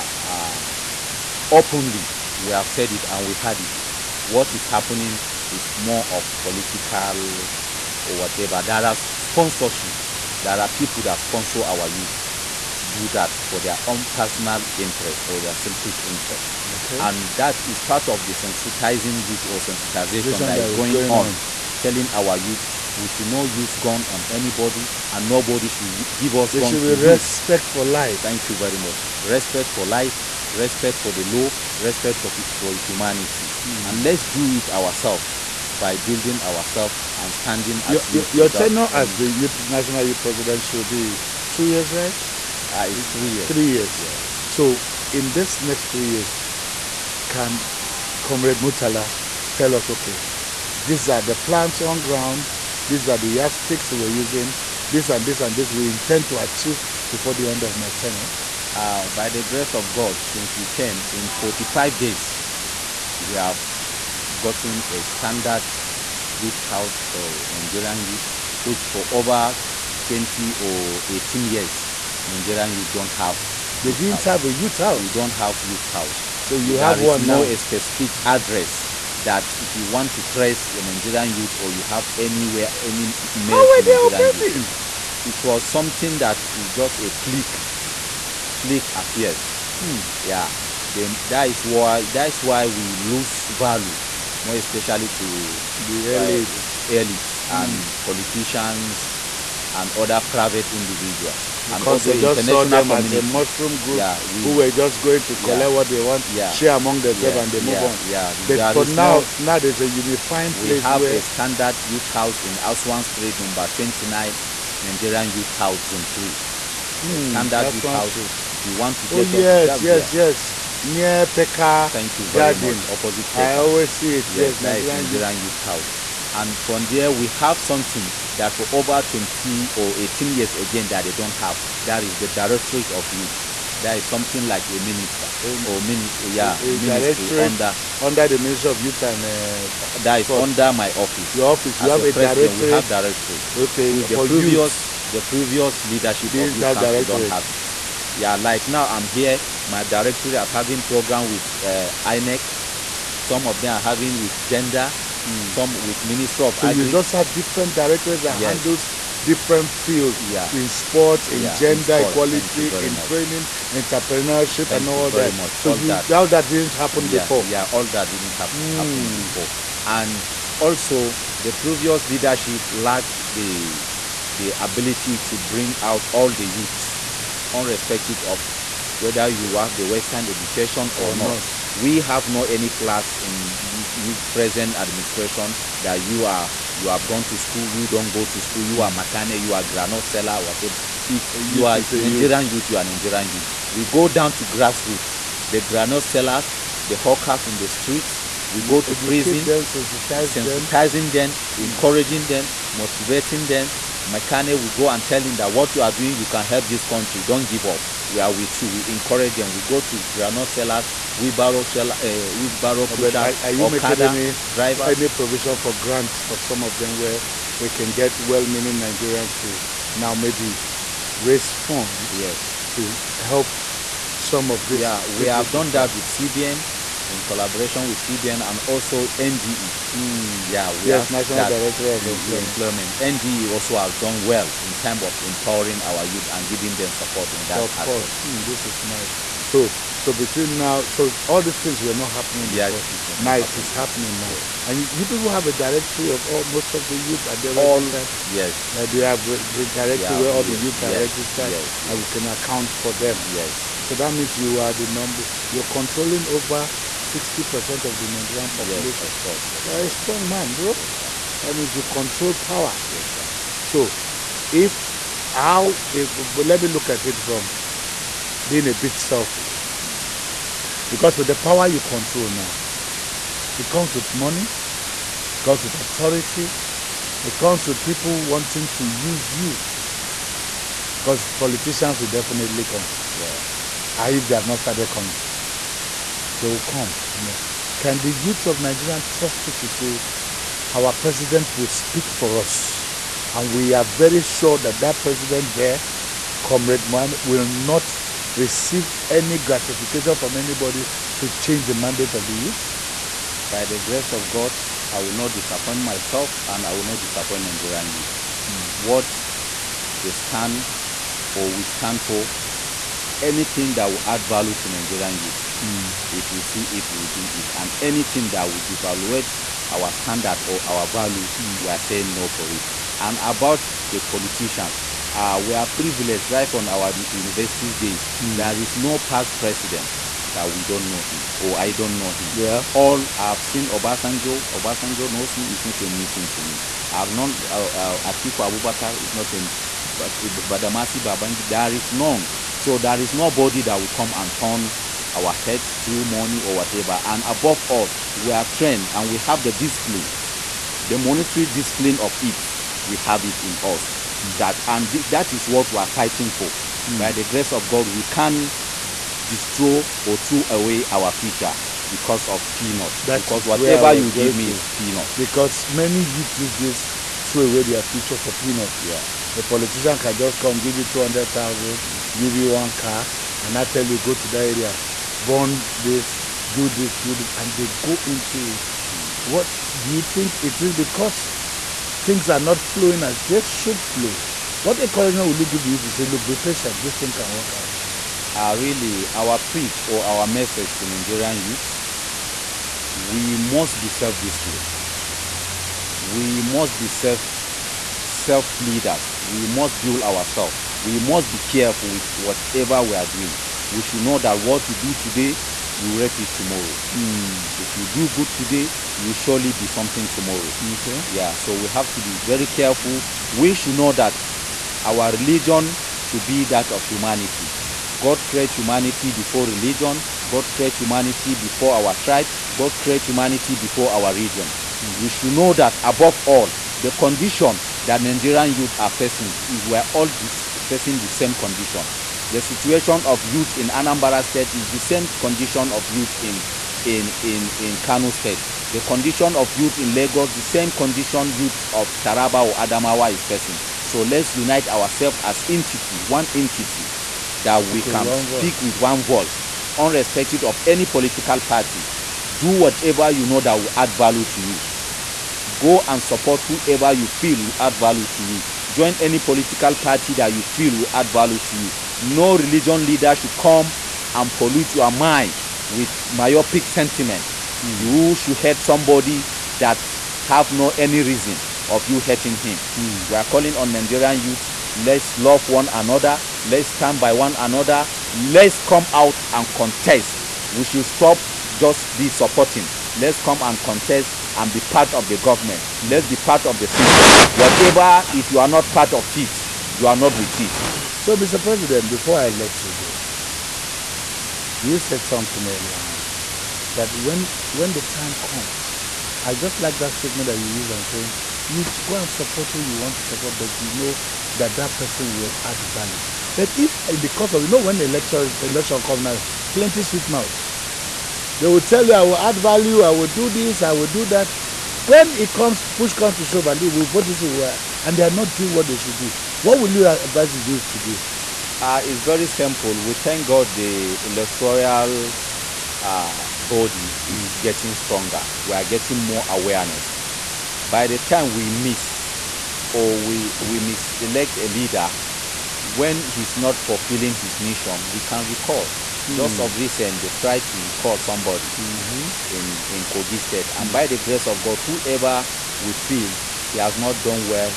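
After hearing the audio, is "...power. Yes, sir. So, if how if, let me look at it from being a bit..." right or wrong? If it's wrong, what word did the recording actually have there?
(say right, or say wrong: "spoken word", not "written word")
right.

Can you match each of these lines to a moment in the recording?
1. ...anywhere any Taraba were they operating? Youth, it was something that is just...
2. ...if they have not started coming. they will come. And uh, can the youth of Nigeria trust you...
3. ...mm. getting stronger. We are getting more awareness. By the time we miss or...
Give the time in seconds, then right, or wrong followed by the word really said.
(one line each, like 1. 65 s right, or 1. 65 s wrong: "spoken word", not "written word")
1. 82 s wrong: "How", not "Taraba"
2. 284 s right
3. 527 s right.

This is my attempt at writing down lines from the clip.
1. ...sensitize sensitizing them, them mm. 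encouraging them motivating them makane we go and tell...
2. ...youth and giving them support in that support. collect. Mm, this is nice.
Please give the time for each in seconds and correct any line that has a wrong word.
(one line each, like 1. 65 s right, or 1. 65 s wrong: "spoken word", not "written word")
1. 199 s right
2. 236 s wrong: "aspect", not "collect".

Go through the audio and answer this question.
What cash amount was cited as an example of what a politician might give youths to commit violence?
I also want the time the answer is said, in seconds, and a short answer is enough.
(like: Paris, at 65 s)
200,000, at 370 s.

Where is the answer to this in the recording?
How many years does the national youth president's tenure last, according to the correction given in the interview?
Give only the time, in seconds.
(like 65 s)
42 s.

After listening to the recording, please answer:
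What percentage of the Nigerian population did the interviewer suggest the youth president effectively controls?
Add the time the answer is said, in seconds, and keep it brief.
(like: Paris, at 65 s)
60 percent, at 257 s.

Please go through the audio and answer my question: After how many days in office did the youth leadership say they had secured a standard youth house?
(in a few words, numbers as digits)
45.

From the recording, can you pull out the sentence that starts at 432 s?
The situation of youth in Anambra State is the same condition of youth in in in in Kano State.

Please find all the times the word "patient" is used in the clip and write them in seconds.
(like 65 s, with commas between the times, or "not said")
386 s.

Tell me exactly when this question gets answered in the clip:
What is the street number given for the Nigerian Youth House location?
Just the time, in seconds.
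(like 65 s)
113 s.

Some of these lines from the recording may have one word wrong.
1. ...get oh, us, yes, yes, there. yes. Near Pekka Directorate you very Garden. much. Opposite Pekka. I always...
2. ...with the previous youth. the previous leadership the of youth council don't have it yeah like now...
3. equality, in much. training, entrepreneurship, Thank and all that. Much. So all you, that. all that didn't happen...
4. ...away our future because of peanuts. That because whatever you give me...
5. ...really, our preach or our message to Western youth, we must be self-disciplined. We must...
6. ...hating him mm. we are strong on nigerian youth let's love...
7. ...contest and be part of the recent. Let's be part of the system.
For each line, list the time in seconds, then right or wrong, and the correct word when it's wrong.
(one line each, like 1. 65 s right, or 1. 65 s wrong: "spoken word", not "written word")
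1. 119 s wrong: "Thank", not "Directorate"
2. 143 s right
3. 162 s right
4. 360 s right
5. 388 s wrong: "Nigerian", not "Western"
6. 472 s wrong: "calling", not "strong"
7. 483 s wrong: "government", not "recent".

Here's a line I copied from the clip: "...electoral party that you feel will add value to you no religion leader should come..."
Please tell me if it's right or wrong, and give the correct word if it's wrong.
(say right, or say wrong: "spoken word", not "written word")
wrong: "political", not "electoral".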